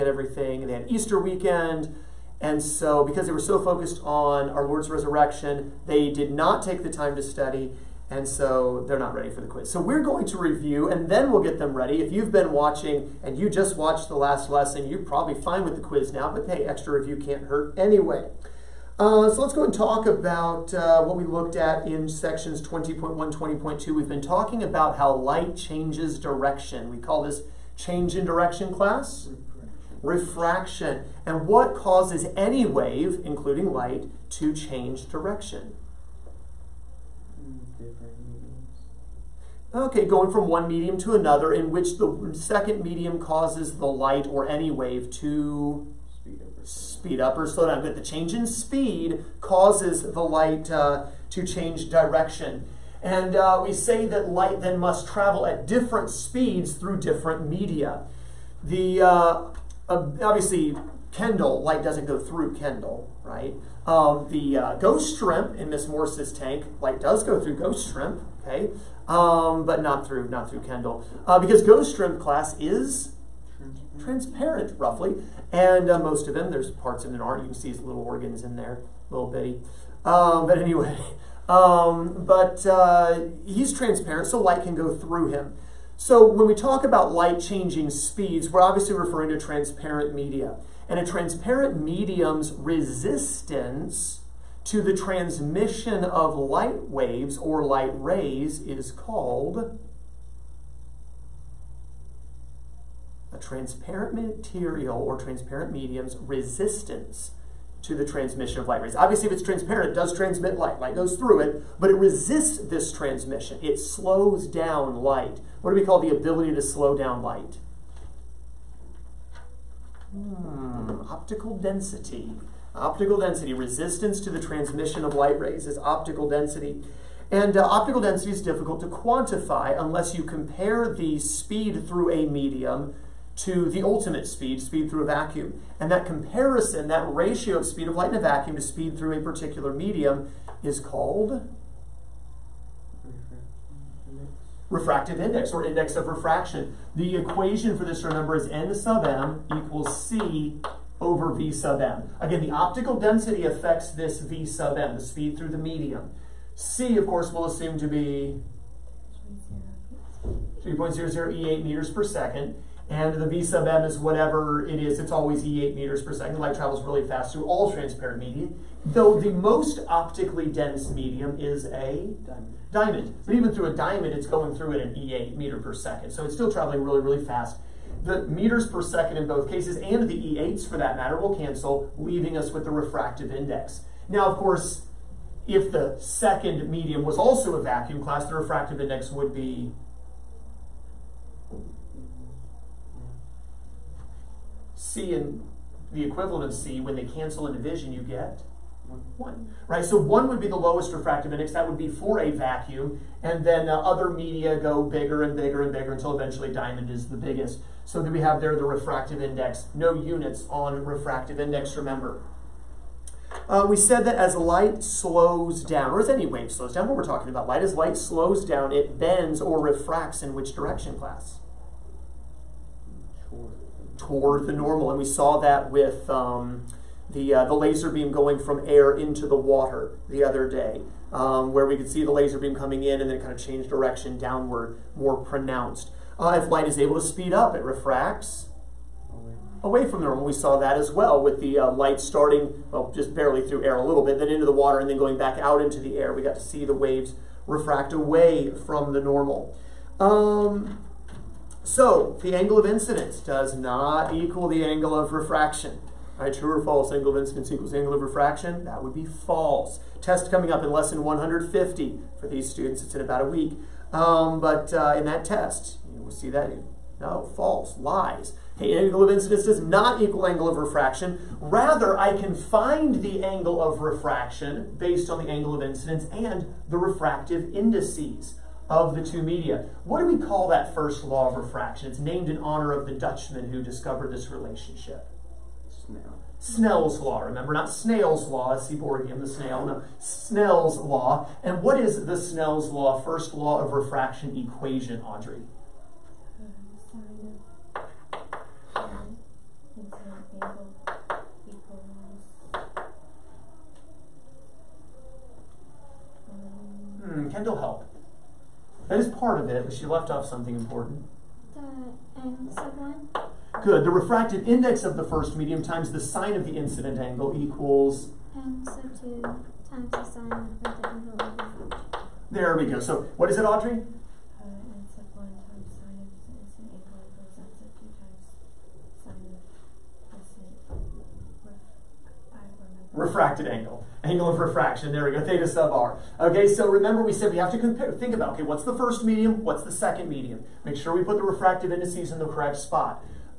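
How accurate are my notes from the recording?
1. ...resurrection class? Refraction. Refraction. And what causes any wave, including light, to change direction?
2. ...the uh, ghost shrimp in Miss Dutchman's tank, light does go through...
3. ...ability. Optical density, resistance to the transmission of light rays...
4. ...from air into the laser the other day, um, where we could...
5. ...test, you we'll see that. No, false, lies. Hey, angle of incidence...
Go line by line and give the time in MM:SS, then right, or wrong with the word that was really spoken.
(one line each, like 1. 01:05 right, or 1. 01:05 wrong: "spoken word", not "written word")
1. 00:28 wrong: "direction", not "resurrection"
2. 01:04 wrong: "Morse", not "Dutchman"
3. 02:01 wrong: "density", not "ability"
4. 03:48 wrong: "water", not "laser"
5. 04:25 right.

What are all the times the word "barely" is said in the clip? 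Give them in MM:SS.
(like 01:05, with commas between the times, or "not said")
04:03.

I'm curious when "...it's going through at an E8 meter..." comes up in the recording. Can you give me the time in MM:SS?
02:54.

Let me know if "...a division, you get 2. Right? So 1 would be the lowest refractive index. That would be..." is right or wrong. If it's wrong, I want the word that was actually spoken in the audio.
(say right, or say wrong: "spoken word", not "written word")
wrong: "1", not "2".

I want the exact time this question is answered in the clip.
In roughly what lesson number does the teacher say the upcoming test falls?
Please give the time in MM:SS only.
04:20.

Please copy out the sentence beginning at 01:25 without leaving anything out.
So when we talk about light changing speeds, we're obviously referring to transparent media.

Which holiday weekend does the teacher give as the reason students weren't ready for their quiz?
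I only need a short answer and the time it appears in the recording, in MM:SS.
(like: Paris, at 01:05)
Easter, at 00:00.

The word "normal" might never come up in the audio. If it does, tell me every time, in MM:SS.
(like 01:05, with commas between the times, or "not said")
03:44, 04:00, 04:09.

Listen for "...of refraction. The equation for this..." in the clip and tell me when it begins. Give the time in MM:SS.
02:25.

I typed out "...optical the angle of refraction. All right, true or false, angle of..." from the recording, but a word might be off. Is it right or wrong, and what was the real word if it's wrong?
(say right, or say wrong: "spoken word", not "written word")
wrong: "equal", not "optical".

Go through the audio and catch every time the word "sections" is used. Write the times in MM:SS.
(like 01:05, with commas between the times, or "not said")
00:22.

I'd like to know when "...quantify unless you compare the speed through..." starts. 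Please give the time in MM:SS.
02:08.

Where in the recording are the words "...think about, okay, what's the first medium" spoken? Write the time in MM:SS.
05:37.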